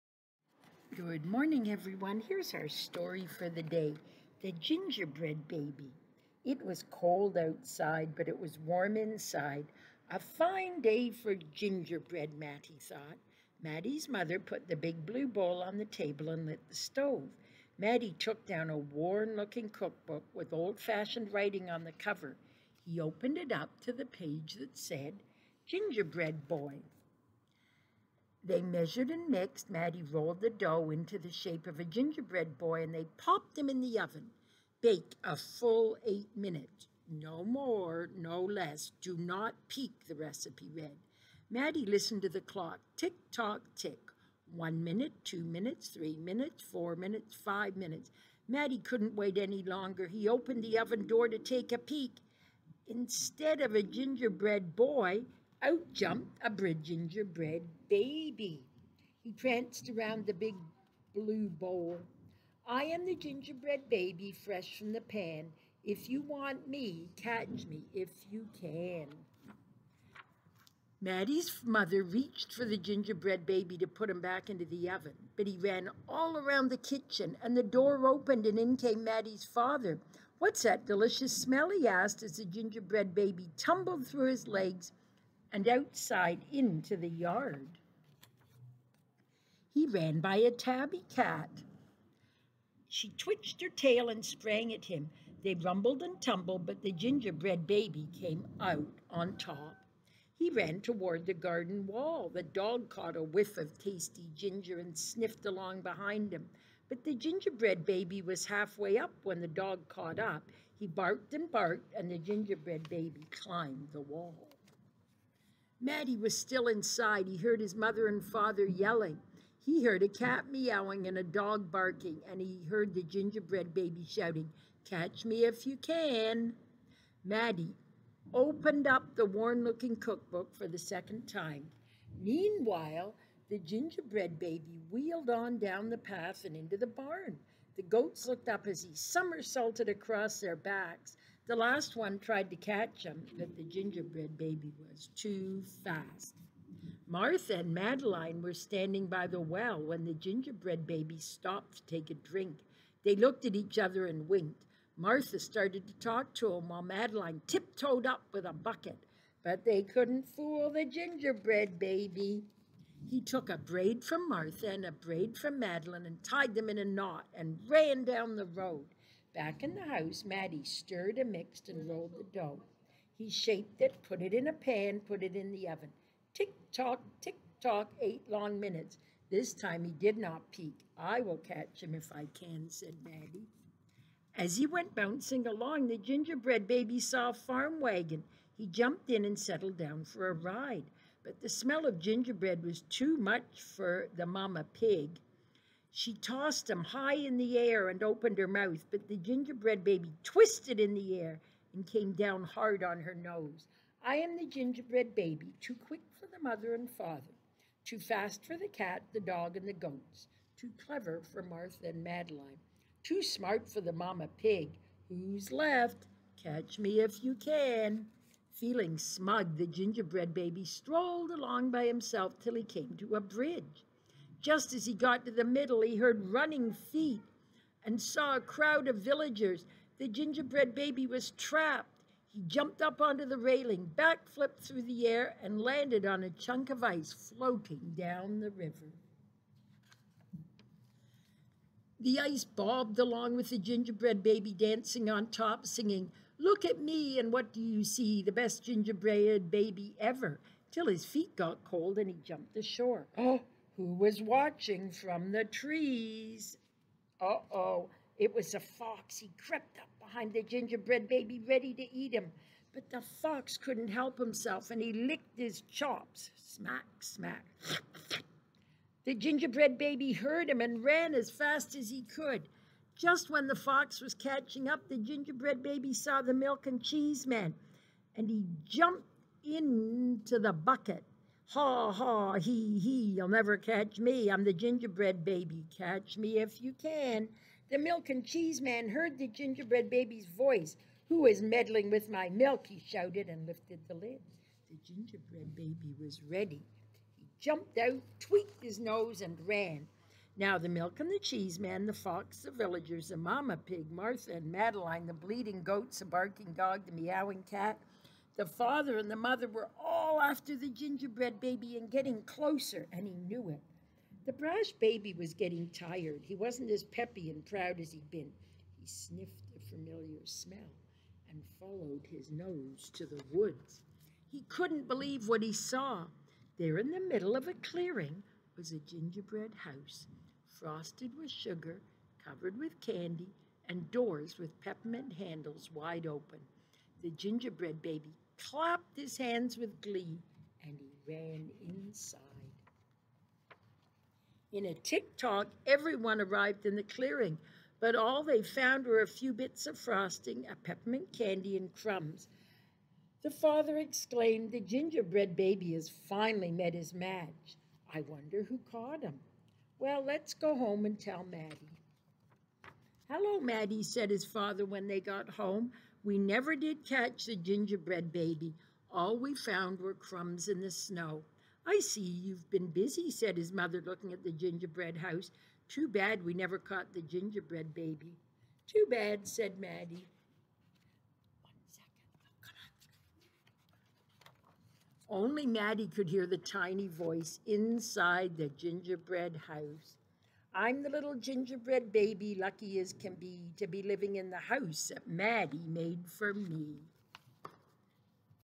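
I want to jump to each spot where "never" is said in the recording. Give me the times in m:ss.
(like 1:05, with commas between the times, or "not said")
4:43, 6:06, 6:16.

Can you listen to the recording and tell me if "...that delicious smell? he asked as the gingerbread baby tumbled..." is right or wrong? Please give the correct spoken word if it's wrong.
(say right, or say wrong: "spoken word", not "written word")
right.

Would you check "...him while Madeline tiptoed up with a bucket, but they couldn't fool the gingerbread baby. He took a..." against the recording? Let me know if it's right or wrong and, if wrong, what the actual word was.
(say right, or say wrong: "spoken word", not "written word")
right.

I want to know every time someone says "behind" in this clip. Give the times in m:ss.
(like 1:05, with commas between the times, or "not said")
1:45, 4:19.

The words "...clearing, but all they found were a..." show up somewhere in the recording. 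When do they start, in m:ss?
5:46.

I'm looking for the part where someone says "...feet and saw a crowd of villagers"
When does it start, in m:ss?
3:46.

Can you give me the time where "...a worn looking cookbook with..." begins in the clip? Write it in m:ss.
0:18.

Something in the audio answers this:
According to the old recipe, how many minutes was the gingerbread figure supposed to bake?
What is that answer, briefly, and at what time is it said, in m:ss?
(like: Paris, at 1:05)
8, at 0:36.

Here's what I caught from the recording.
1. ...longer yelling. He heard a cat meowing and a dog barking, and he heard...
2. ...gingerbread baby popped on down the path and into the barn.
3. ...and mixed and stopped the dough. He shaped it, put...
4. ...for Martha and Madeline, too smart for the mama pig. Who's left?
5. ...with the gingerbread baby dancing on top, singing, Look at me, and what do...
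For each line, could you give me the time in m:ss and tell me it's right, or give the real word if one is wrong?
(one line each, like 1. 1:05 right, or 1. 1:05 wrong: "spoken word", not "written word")
1. 1:58 wrong: "father", not "longer"
2. 2:13 wrong: "wheeled", not "popped"
3. 2:51 wrong: "rolled", not "stopped"
4. 3:31 right
5. 4:03 right.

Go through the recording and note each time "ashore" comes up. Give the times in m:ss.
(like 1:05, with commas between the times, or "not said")
4:12.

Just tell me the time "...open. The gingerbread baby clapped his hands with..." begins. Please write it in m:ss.
5:36.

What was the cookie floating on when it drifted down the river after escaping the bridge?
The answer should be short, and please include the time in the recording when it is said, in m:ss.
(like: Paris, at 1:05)
chunk of ice, at 3:56.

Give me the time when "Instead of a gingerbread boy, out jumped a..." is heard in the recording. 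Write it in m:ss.
0:52.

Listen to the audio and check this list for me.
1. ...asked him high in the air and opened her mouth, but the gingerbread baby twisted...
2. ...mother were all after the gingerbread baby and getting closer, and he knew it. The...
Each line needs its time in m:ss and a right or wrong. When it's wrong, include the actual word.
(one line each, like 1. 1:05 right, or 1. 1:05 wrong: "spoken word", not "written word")
1. 3:16 wrong: "tossed", not "asked"
2. 5:09 right.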